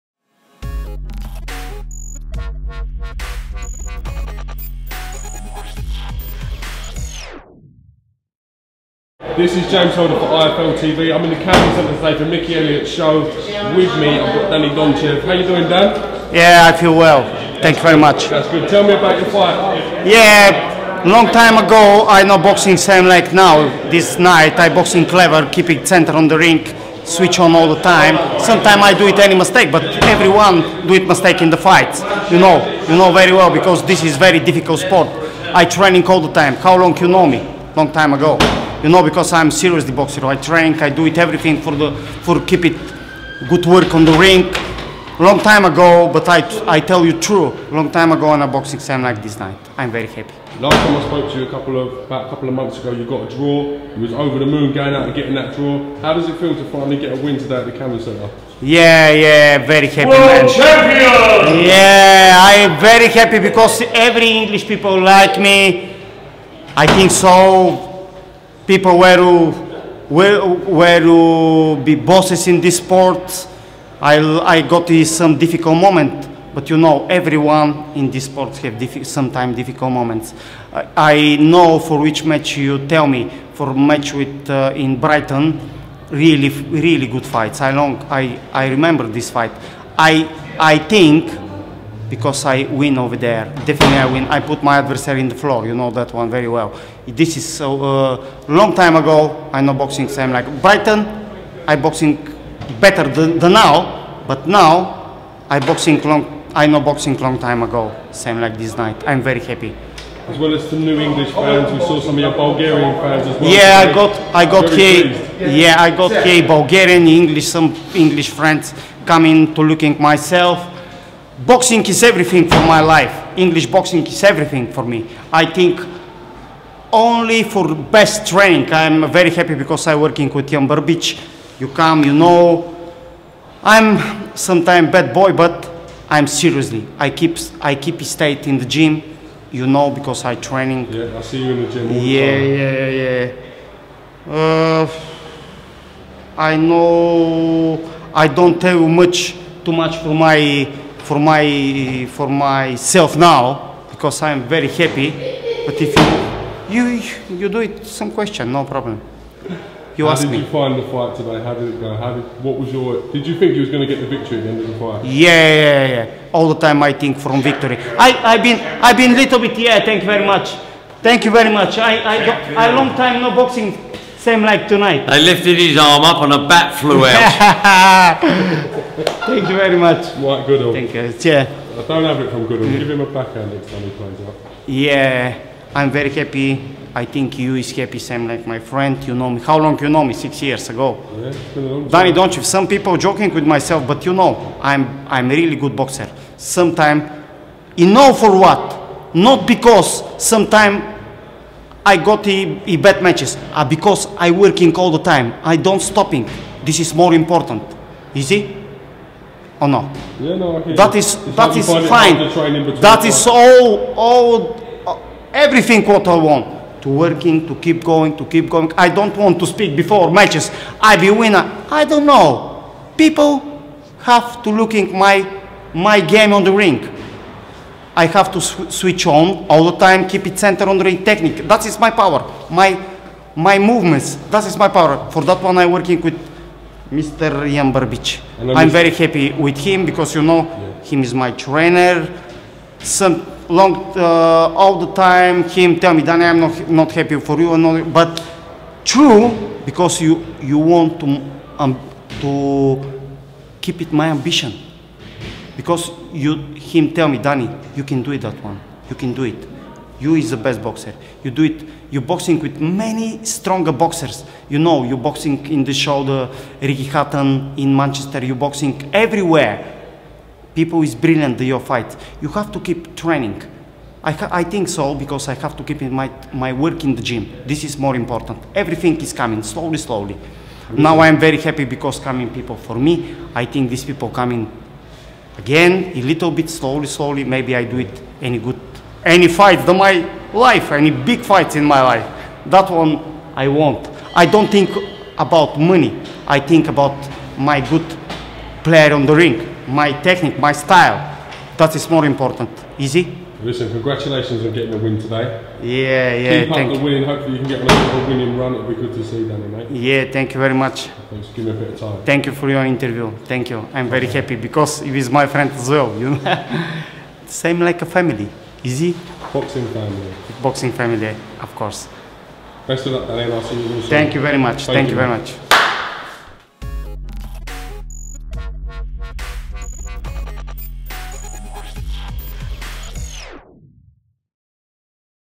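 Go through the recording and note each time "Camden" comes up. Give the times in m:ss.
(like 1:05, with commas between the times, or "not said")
0:11, 0:57.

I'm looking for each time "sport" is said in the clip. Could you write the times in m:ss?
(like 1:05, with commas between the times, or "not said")
0:34, 1:12, 1:18.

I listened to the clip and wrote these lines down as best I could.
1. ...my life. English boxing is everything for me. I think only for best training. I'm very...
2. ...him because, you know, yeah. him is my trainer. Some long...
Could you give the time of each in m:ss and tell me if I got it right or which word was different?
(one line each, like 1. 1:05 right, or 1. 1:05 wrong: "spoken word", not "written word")
1. 2:02 right
2. 3:59 right.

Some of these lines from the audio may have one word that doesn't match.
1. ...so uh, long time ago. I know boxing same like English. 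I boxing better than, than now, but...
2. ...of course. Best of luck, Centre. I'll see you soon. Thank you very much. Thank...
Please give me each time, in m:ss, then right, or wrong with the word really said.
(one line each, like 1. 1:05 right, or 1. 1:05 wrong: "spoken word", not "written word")
1. 1:37 wrong: "Brighton", not "English"
2. 5:21 wrong: "Danny", not "Centre".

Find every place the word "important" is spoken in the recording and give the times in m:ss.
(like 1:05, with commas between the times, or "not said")
3:27, 4:37, 5:02.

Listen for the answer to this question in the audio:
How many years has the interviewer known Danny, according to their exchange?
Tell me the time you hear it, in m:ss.
3:10.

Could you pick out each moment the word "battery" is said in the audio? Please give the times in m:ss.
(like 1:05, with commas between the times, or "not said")
not said.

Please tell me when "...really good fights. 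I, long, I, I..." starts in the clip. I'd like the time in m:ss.
1:26.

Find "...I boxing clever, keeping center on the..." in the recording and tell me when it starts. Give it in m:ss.
0:24.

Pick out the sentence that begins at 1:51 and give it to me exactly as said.
We saw some of your Bulgarian fans as well.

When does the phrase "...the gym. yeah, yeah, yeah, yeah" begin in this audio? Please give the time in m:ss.
2:21.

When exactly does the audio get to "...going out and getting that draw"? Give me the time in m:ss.
0:54.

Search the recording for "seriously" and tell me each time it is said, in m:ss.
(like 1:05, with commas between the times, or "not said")
0:39, 2:16.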